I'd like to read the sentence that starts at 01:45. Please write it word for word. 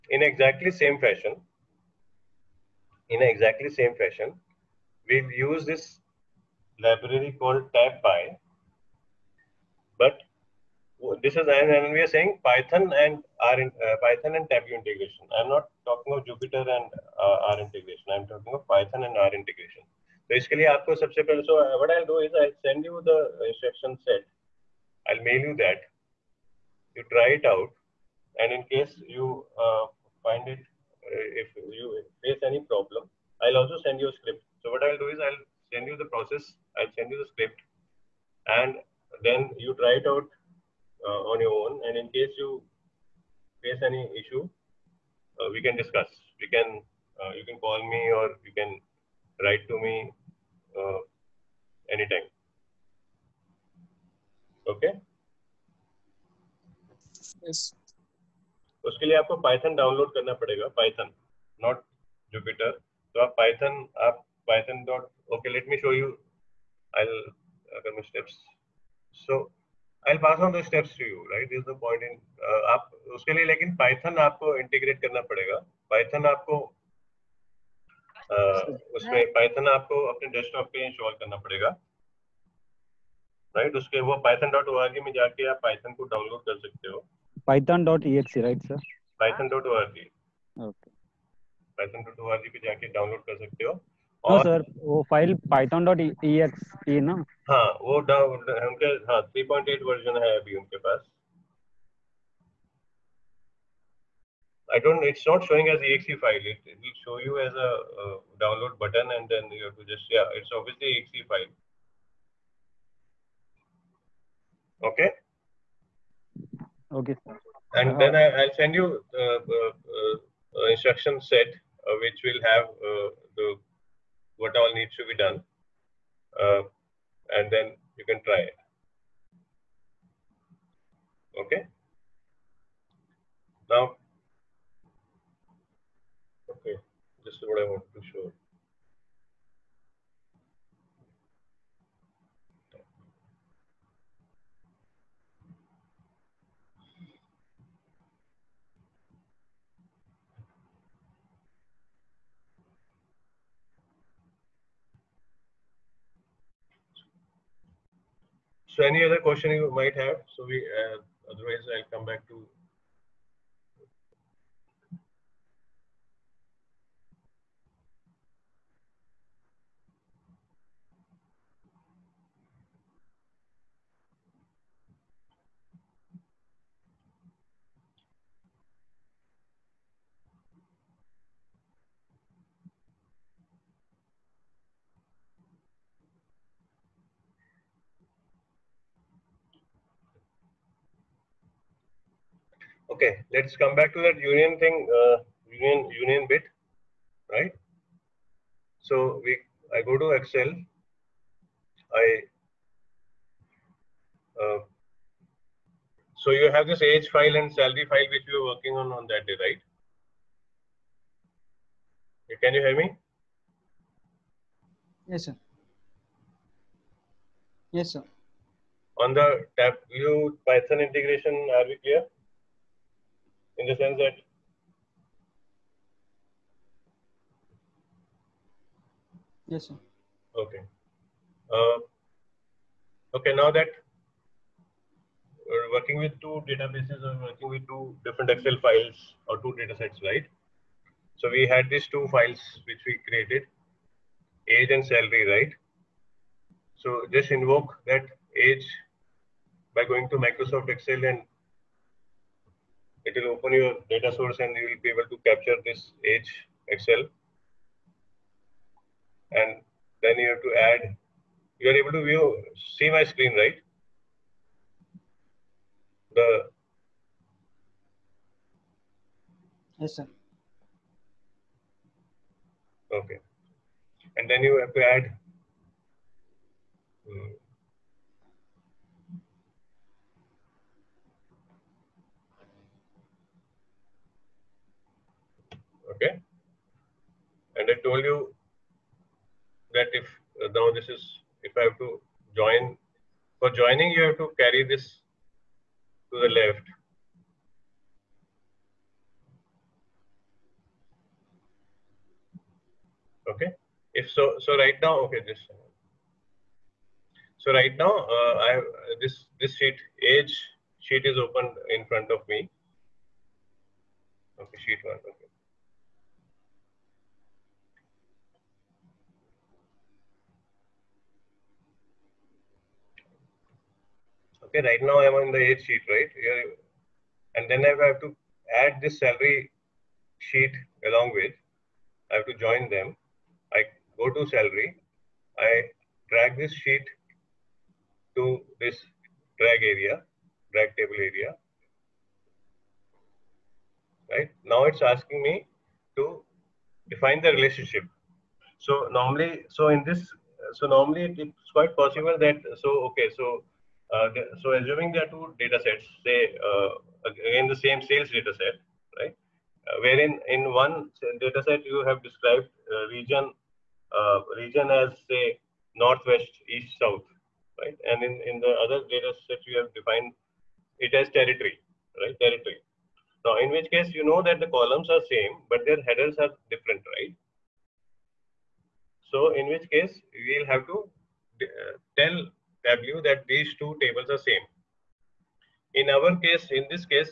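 It's not showing as exe file.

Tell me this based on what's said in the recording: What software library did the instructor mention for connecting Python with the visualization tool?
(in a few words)
tab by.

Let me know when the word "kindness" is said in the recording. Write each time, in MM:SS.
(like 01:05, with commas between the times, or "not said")
not said.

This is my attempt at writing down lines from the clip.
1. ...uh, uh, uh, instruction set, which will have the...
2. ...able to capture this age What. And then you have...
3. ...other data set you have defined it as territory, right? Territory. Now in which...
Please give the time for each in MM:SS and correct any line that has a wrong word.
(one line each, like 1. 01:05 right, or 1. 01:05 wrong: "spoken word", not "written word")
1. 01:59 right
2. 04:14 wrong: "Excel", not "What"
3. 06:08 right.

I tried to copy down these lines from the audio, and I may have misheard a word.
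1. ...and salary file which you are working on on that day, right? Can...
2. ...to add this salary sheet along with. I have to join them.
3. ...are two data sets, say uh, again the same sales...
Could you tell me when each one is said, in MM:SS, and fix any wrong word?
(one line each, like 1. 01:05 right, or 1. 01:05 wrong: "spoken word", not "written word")
1. 03:27 right
2. 05:27 right
3. 05:55 right.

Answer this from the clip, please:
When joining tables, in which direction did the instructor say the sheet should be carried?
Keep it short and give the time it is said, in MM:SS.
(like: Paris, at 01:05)
to the left, at 04:56.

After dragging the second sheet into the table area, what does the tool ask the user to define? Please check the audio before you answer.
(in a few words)
the relationship.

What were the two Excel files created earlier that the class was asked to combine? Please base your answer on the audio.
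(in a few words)
age and salary.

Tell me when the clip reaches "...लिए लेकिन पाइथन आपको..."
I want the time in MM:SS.
01:13.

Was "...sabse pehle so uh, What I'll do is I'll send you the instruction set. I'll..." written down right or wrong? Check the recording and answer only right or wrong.
right.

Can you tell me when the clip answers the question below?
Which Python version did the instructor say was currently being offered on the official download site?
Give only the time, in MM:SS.
01:39.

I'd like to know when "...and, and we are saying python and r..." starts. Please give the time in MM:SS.
00:11.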